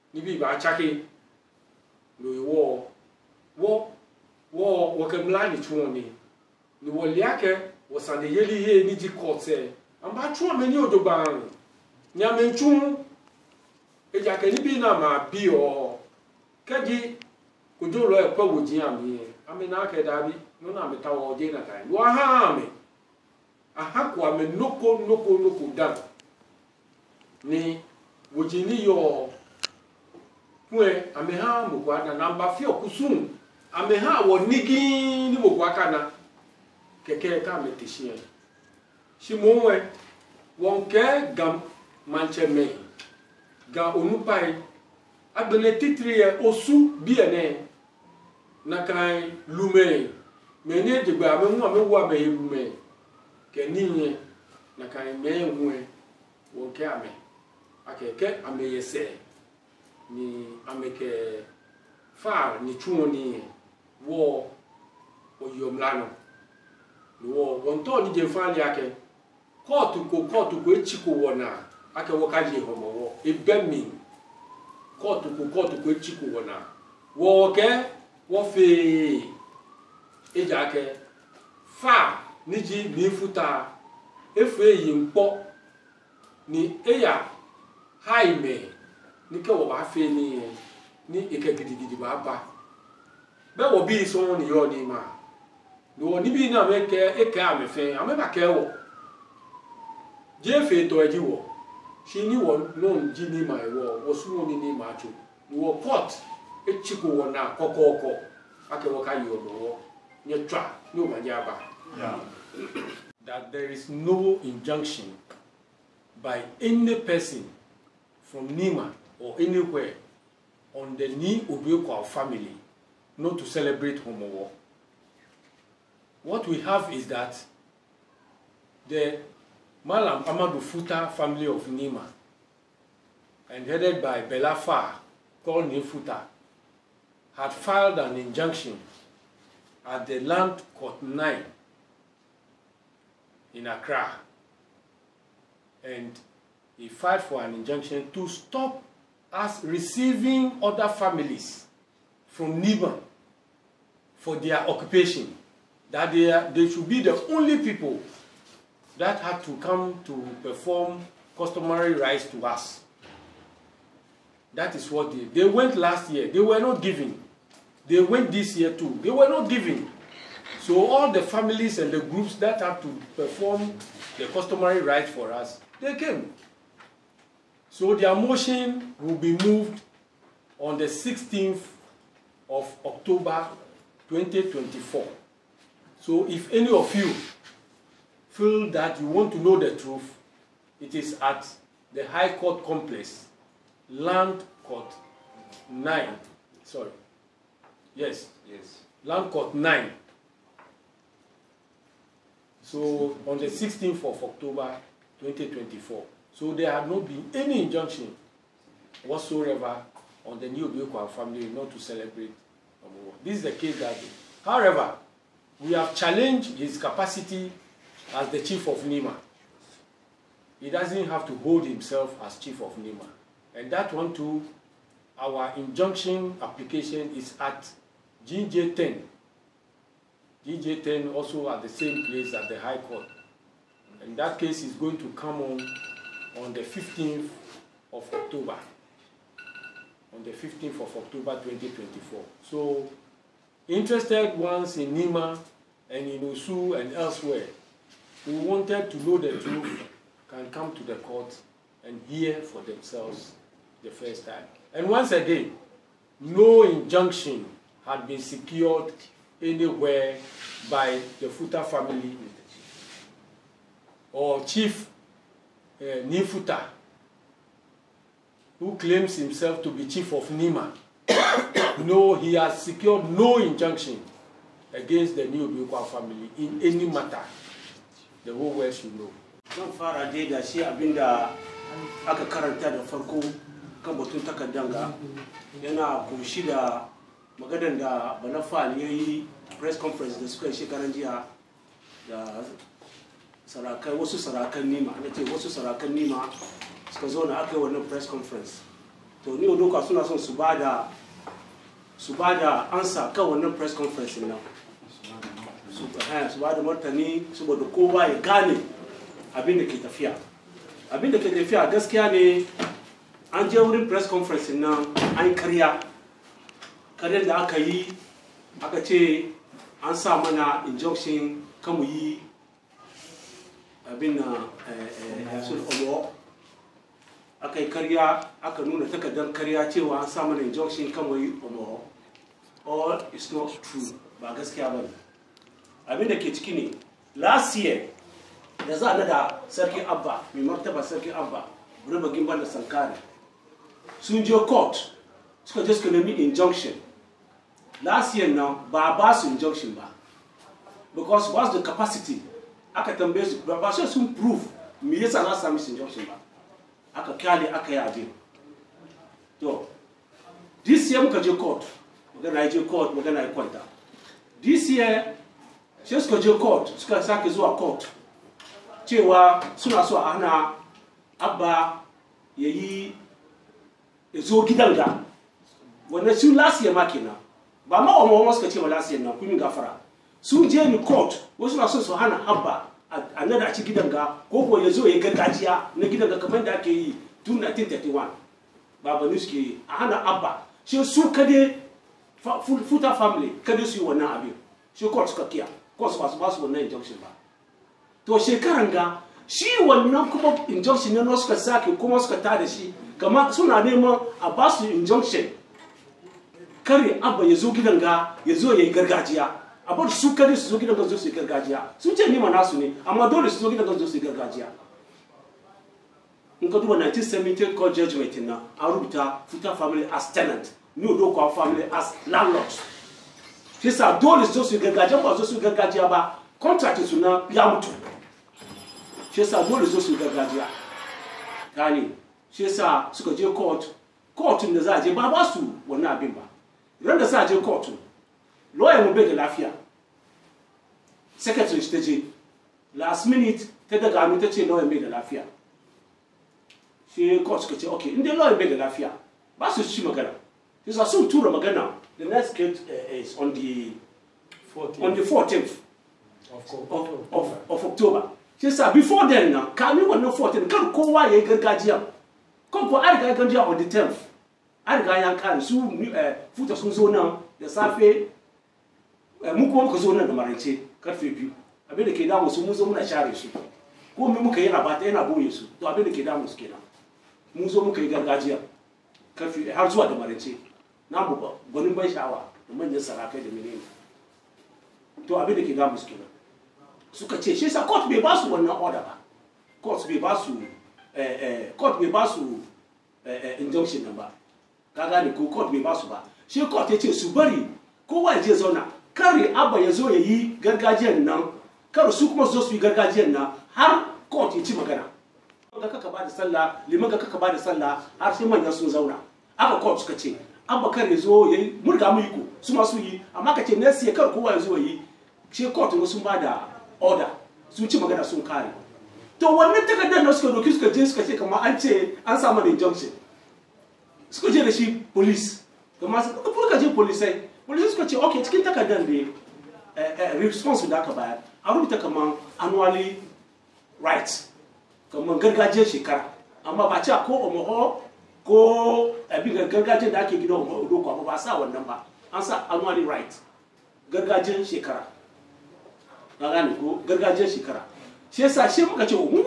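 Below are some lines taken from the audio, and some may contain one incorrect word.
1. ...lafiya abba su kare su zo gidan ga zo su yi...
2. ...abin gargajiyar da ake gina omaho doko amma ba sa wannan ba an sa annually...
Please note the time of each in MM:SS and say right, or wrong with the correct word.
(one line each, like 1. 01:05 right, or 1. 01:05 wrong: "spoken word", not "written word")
1. 06:48 wrong: "gargajiya", not "lafiya"
2. 08:59 right.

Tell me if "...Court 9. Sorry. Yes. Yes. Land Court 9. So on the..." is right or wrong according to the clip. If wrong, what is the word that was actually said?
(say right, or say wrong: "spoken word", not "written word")
right.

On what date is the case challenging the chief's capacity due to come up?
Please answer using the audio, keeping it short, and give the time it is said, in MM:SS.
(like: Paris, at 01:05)
15 October 2024, at 04:00.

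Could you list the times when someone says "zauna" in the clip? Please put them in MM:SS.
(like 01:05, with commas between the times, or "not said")
08:18, 08:28.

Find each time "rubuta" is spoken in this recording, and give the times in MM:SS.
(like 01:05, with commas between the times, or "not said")
06:58, 08:51.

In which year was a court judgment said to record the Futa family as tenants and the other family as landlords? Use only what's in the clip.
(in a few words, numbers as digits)
1978.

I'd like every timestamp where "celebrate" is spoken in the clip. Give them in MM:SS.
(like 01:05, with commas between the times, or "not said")
02:03, 03:31.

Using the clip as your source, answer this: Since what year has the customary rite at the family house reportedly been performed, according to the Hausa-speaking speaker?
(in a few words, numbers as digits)
1931.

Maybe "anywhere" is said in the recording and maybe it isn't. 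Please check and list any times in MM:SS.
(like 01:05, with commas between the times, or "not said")
01:59, 04:19.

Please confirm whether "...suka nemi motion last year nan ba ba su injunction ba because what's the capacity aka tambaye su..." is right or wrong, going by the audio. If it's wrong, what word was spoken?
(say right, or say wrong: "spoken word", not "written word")
wrong: "injunction", not "motion".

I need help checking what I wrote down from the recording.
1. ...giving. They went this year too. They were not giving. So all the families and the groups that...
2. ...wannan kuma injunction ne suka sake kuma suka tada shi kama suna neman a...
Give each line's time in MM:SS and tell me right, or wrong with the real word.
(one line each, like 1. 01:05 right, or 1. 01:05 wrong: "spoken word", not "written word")
1. 02:46 right
2. 06:39 right.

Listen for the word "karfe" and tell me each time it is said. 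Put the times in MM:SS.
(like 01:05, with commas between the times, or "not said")
07:50, 07:59.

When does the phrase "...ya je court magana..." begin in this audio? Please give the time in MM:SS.
06:02.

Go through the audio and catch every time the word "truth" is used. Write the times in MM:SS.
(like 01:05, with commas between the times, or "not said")
03:09, 04:09.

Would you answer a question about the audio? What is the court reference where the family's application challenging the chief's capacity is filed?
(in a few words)
GJ10.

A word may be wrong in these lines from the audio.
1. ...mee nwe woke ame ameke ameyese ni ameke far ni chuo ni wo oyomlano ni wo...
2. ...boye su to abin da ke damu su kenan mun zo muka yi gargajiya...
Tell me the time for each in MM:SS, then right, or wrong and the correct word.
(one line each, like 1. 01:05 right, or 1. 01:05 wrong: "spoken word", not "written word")
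1. 00:55 wrong: "akeke", not "ameke"
2. 07:55 right.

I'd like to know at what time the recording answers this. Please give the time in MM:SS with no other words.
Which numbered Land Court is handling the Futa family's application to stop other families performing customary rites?
02:20.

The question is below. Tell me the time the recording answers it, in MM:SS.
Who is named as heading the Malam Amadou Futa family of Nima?
02:14.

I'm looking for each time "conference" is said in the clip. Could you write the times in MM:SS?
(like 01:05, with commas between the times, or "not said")
04:49, 04:58, 05:03, 05:14.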